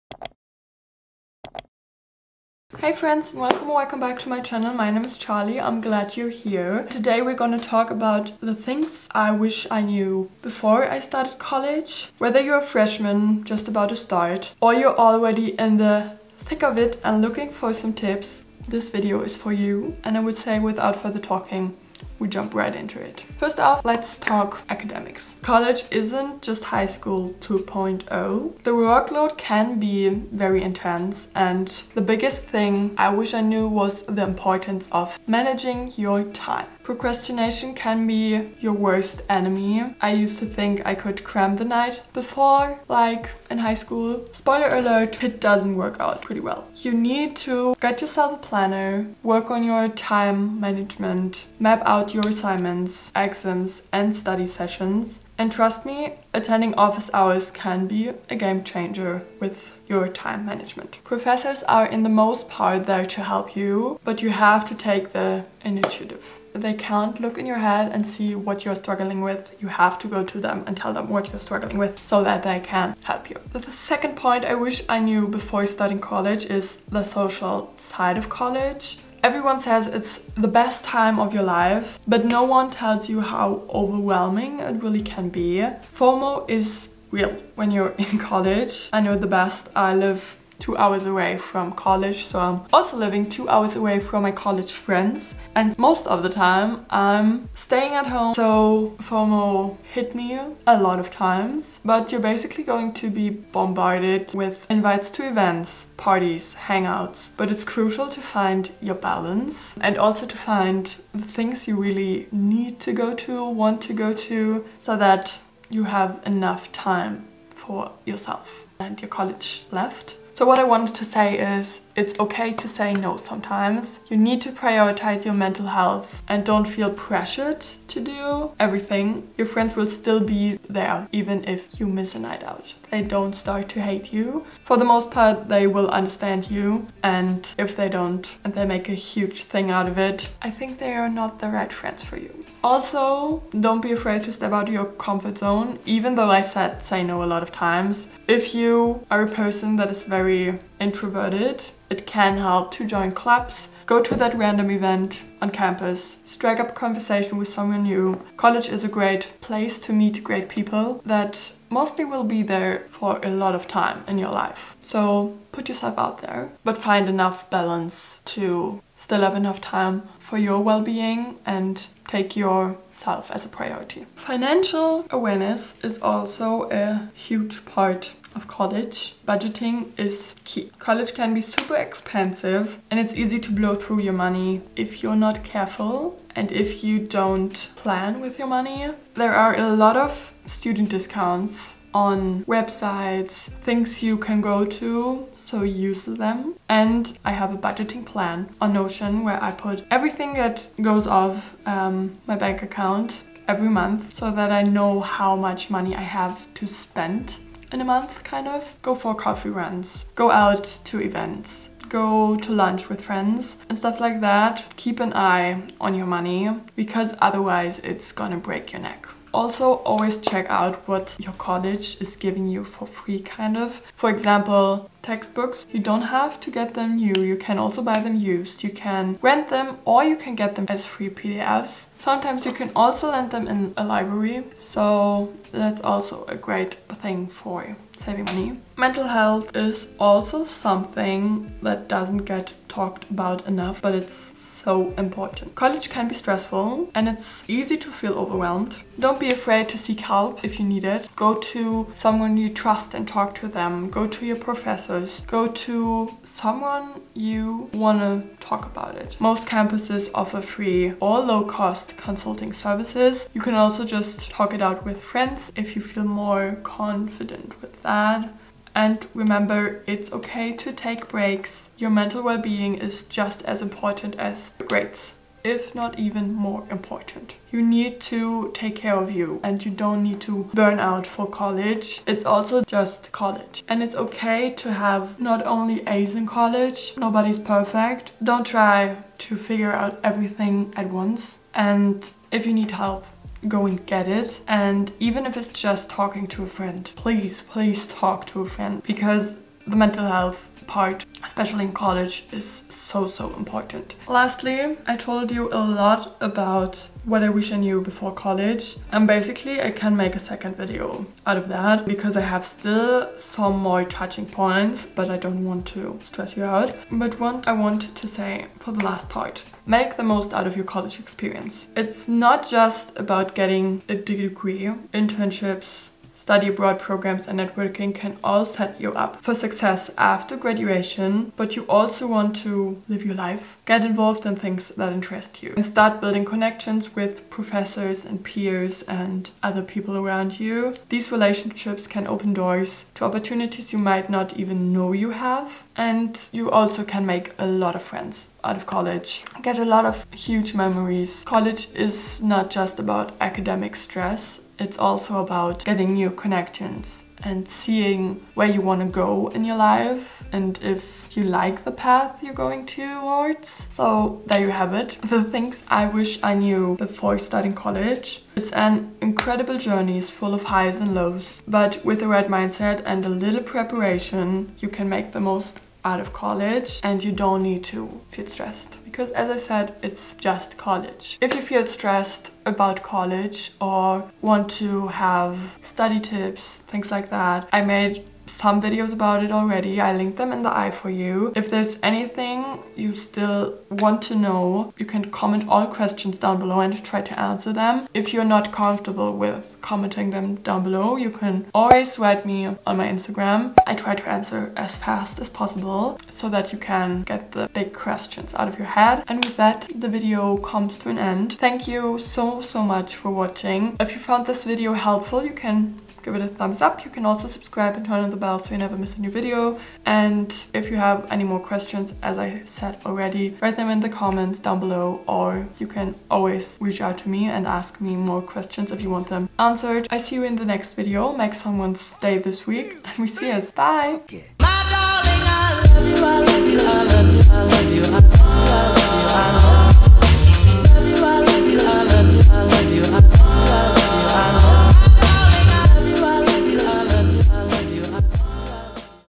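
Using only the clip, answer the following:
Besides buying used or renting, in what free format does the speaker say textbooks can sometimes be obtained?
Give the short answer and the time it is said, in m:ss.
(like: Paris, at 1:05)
PDFs, at 3:50.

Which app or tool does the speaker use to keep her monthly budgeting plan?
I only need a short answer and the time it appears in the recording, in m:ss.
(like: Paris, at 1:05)
Notion, at 3:18.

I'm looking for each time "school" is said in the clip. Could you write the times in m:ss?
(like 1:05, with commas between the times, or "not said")
0:26, 0:43.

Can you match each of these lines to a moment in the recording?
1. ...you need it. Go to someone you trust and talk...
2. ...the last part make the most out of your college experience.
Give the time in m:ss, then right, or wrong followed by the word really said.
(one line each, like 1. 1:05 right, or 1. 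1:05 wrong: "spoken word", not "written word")
1. 4:10 right
2. 5:18 right.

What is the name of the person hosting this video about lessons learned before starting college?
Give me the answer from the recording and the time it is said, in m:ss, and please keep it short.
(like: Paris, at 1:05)
Charly, at 0:05.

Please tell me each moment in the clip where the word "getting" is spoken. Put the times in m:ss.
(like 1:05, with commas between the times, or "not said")
5:23, 5:55.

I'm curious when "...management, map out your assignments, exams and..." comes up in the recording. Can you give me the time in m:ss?
0:50.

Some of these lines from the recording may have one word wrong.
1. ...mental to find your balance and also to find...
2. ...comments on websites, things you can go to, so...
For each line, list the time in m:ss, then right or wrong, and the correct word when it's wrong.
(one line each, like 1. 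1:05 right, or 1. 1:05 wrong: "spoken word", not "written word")
1. 1:47 wrong: "crucial", not "mental"
2. 3:10 wrong: "discounts", not "comments".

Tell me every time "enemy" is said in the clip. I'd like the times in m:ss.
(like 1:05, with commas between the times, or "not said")
0:39.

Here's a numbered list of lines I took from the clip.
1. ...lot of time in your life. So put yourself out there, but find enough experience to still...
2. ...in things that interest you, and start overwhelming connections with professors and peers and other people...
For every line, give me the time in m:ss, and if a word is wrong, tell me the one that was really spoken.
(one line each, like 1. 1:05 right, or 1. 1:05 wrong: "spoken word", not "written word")
1. 2:43 wrong: "balance", not "experience"
2. 5:34 wrong: "building", not "overwhelming".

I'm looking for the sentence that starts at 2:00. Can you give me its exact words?
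So what I wanted to say is, it's okay to say no sometimes.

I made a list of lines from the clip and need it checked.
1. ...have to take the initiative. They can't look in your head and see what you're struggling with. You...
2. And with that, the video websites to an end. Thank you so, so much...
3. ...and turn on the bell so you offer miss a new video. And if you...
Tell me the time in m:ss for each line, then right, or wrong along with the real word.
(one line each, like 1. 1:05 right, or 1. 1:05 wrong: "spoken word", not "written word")
1. 1:04 right
2. 6:49 wrong: "comes", not "websites"
3. 6:57 wrong: "never", not "offer".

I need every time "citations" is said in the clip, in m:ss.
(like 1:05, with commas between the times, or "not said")
not said.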